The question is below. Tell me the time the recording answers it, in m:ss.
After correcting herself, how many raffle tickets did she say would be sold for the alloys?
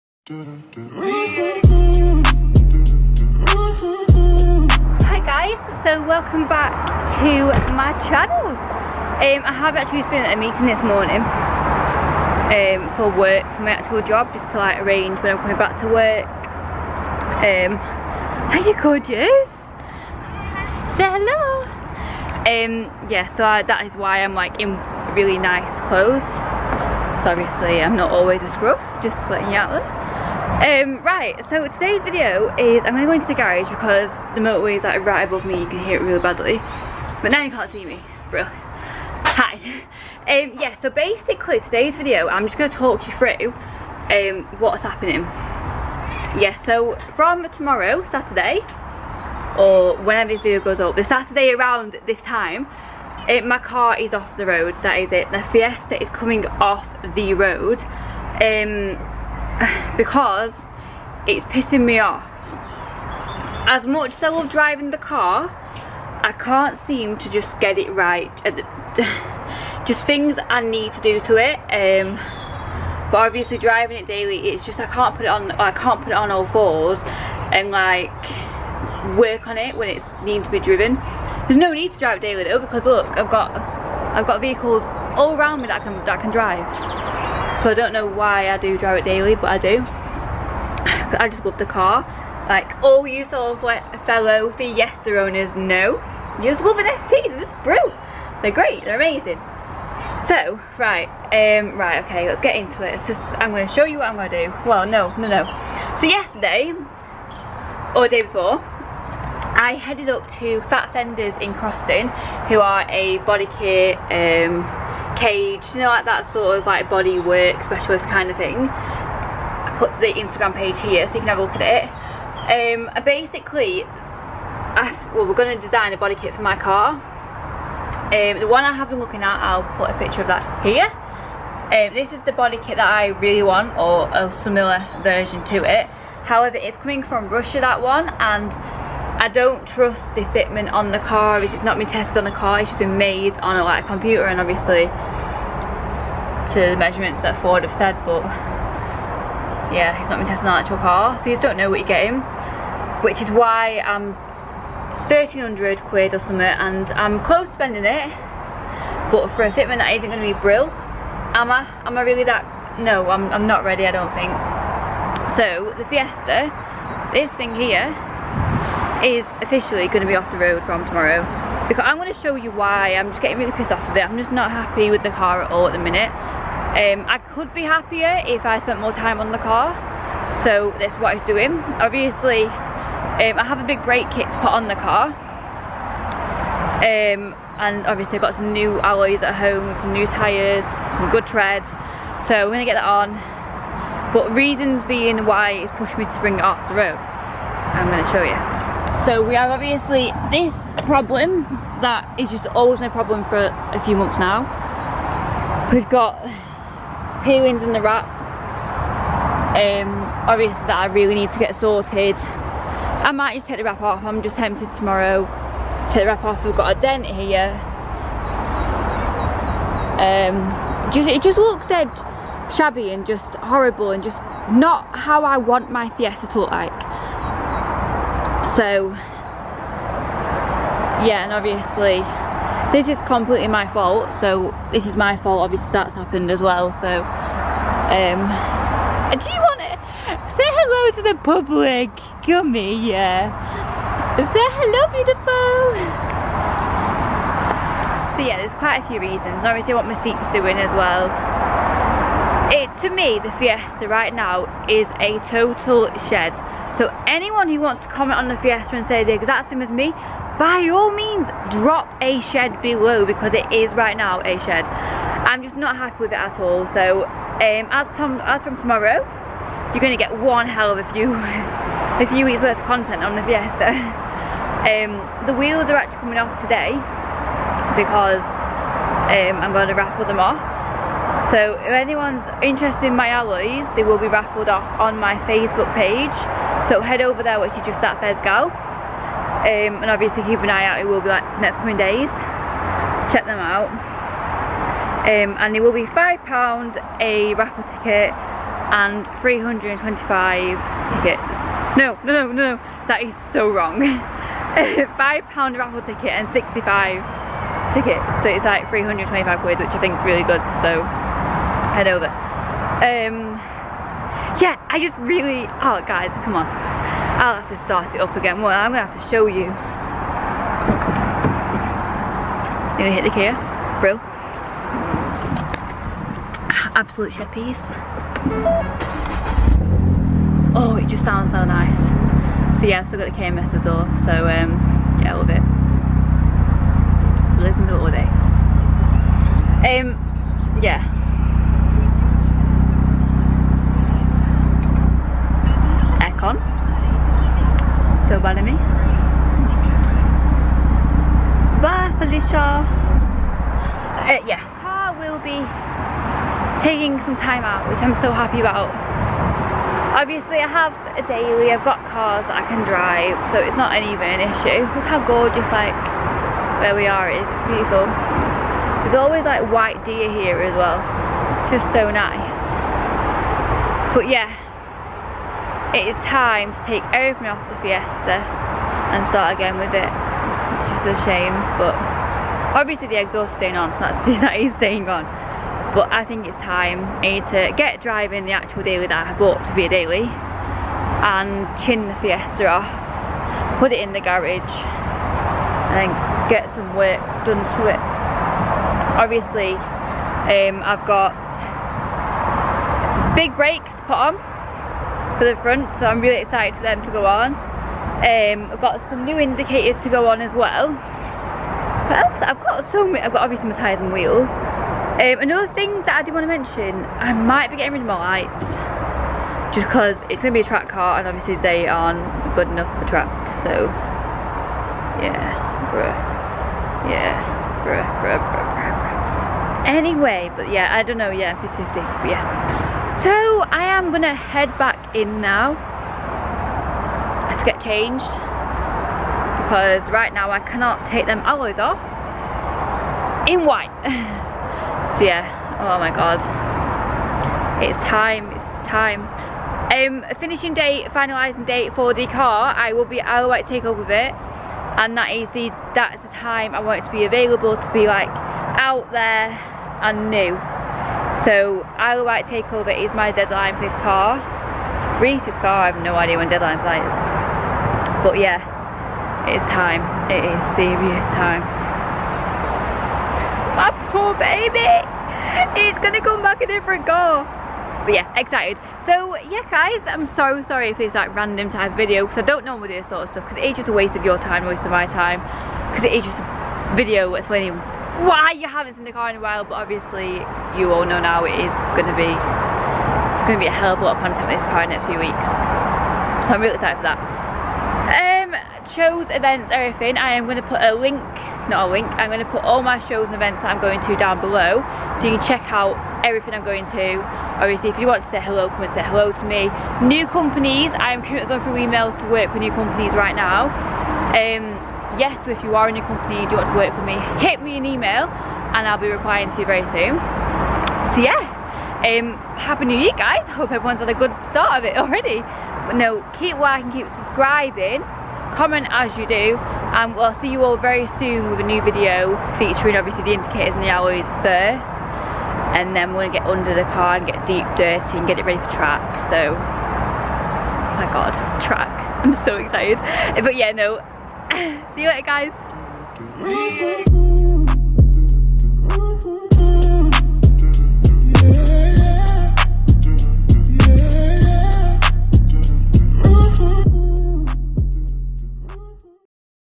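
5:06.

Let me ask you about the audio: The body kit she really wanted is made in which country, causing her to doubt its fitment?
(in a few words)
Russia.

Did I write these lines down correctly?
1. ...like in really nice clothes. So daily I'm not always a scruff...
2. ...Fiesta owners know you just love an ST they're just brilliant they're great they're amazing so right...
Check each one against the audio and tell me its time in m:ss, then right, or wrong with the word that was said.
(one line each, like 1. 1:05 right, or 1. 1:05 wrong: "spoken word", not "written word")
1. 0:24 wrong: "obviously", not "daily"
2. 1:34 right.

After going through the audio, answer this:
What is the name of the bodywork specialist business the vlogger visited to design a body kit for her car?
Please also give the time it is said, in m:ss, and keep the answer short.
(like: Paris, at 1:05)
Fat Fenders, at 1:50.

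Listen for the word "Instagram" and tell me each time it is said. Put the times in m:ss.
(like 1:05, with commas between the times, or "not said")
2:00.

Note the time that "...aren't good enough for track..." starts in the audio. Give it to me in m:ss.
7:01.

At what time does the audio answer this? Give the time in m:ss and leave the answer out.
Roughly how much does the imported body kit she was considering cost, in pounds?
2:35.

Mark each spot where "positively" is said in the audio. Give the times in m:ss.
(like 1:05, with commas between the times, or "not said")
not said.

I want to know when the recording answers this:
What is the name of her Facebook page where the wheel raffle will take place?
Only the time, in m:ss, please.
4:48.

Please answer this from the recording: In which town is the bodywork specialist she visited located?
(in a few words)
Croston.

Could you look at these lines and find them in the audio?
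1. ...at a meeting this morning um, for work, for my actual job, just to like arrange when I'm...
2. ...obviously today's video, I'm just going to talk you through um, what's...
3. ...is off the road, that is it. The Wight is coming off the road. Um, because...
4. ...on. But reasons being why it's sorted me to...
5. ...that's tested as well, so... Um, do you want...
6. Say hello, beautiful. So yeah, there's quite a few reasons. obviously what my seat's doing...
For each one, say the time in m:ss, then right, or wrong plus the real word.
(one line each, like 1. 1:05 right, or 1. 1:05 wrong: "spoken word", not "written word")
1. 0:10 right
2. 0:40 wrong: "basically", not "obviously"
3. 0:53 wrong: "Fiesta", not "Wight"
4. 3:12 wrong: "pushed", not "sorted"
5. 3:55 wrong: "happened", not "tested"
6. 4:04 right.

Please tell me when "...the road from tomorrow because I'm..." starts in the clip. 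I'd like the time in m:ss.
2:50.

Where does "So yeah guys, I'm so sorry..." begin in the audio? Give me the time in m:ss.
7:58.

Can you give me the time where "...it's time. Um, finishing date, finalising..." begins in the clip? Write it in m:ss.
7:28.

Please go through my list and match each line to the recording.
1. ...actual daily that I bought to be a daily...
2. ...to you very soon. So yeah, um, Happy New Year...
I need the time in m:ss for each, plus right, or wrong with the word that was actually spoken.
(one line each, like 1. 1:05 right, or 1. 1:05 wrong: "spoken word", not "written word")
1. 6:28 right
2. 8:39 right.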